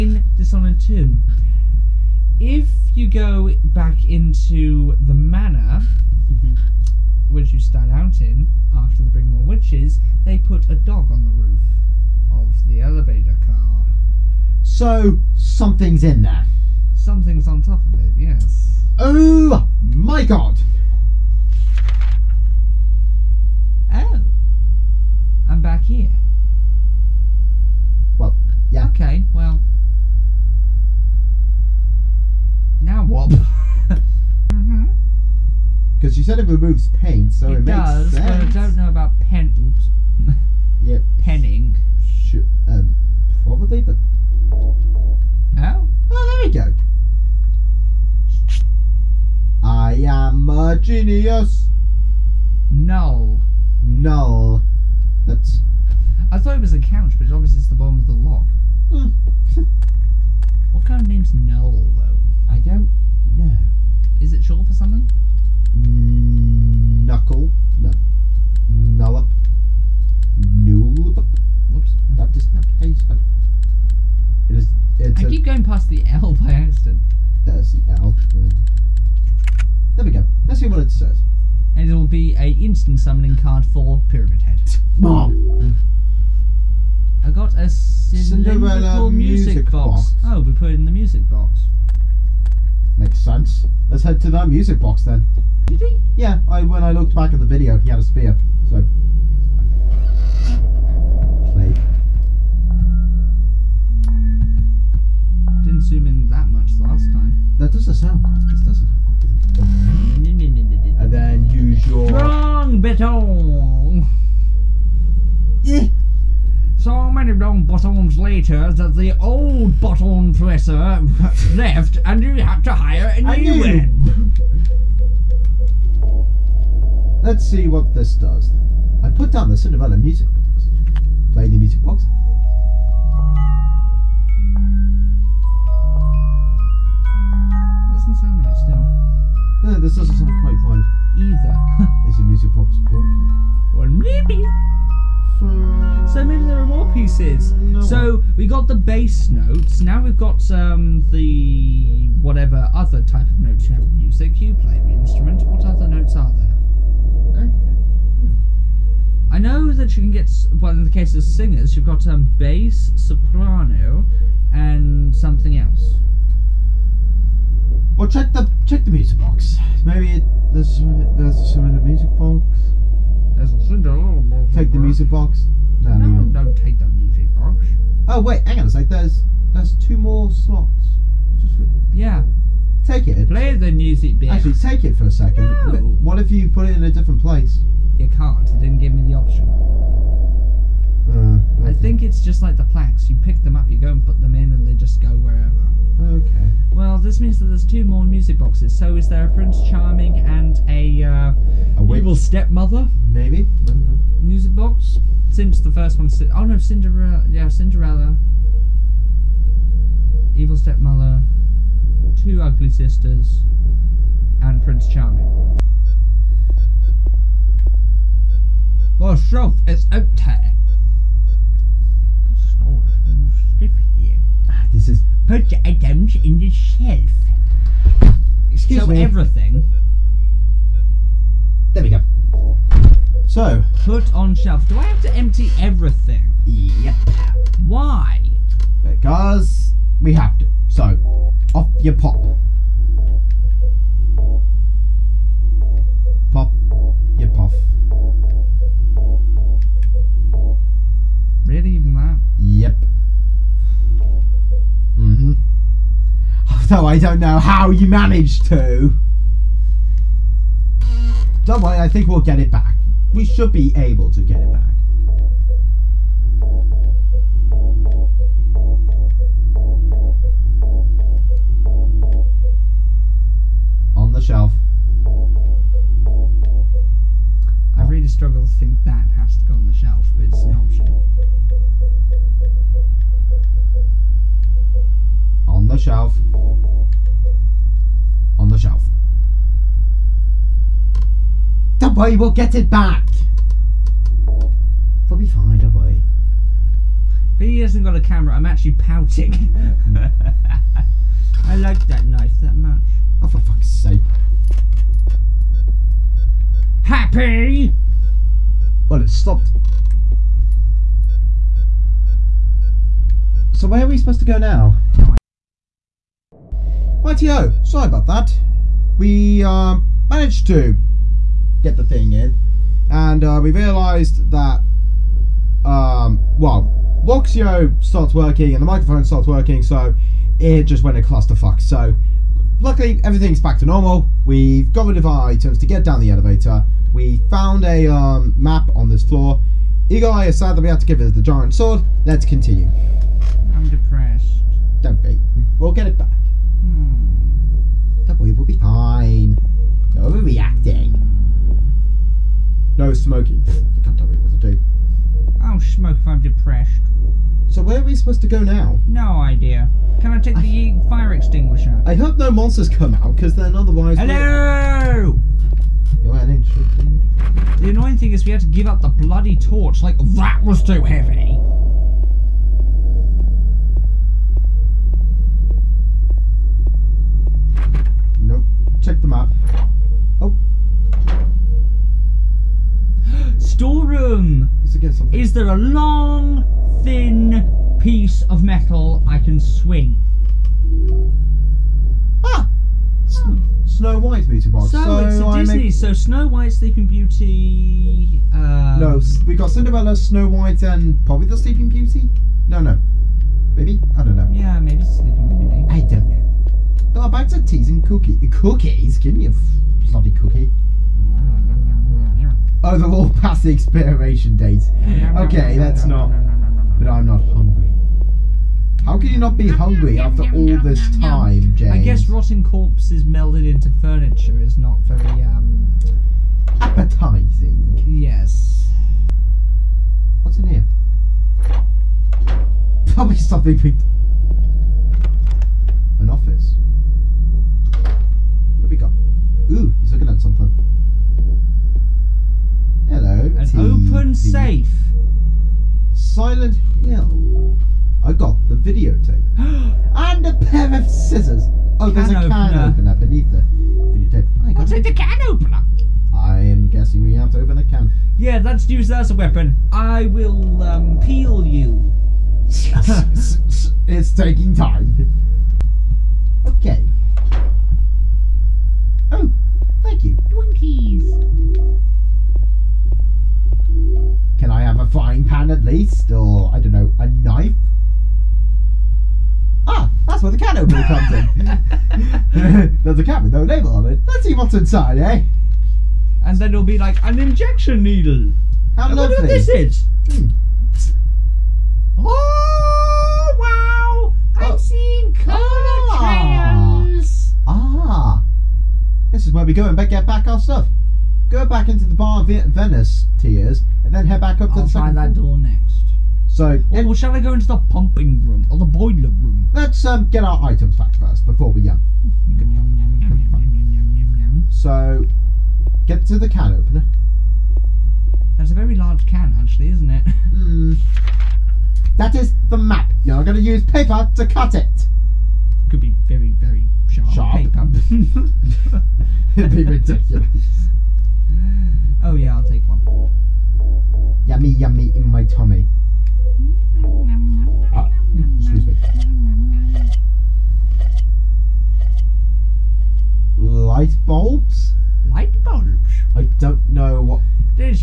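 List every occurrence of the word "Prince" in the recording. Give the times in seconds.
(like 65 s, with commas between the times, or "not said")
199 s, 214 s.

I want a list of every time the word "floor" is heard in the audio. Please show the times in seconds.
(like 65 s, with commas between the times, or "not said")
339 s, 505 s.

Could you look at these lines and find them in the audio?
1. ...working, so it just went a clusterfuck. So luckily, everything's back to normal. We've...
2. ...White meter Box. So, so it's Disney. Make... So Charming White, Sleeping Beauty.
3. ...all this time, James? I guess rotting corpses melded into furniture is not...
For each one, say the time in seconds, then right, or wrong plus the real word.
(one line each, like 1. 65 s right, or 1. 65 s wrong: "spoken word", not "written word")
1. 329 s right
2. 393 s wrong: "Snow", not "Charming"
3. 420 s right.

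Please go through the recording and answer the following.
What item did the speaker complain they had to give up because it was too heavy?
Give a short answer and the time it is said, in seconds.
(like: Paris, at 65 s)
torch, at 369 s.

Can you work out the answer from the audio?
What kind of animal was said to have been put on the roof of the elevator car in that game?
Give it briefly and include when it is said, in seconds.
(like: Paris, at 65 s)
dog, at 10 s.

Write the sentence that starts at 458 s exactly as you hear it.
Yeah, let's use that as a weapon.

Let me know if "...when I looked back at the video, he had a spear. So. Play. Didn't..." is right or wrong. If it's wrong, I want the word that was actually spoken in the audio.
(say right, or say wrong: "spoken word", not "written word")
right.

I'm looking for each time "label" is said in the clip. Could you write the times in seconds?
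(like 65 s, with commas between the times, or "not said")
483 s.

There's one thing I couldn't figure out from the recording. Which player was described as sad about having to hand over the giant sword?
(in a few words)
Eagle Eye.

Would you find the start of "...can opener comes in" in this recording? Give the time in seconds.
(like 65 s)
480 s.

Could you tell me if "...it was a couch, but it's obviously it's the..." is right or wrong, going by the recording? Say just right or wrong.
right.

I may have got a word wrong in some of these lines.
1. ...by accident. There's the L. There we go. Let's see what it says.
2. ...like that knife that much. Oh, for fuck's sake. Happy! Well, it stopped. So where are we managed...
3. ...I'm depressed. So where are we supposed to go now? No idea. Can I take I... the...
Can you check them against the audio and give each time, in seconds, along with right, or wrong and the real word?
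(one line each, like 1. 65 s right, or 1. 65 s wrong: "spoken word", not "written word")
1. 76 s right
2. 301 s wrong: "supposed", not "managed"
3. 356 s right.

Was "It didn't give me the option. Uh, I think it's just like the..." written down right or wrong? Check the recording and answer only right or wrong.
right.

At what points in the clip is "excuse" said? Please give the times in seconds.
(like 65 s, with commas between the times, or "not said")
228 s, 538 s.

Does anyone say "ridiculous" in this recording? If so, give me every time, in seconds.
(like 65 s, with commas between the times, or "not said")
529 s.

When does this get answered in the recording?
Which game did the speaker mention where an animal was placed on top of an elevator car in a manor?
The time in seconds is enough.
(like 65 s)
0 s.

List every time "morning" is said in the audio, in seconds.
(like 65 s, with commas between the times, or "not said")
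not said.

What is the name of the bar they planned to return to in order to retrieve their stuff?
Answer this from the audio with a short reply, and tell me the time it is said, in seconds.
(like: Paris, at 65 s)
Venus Tears, at 502 s.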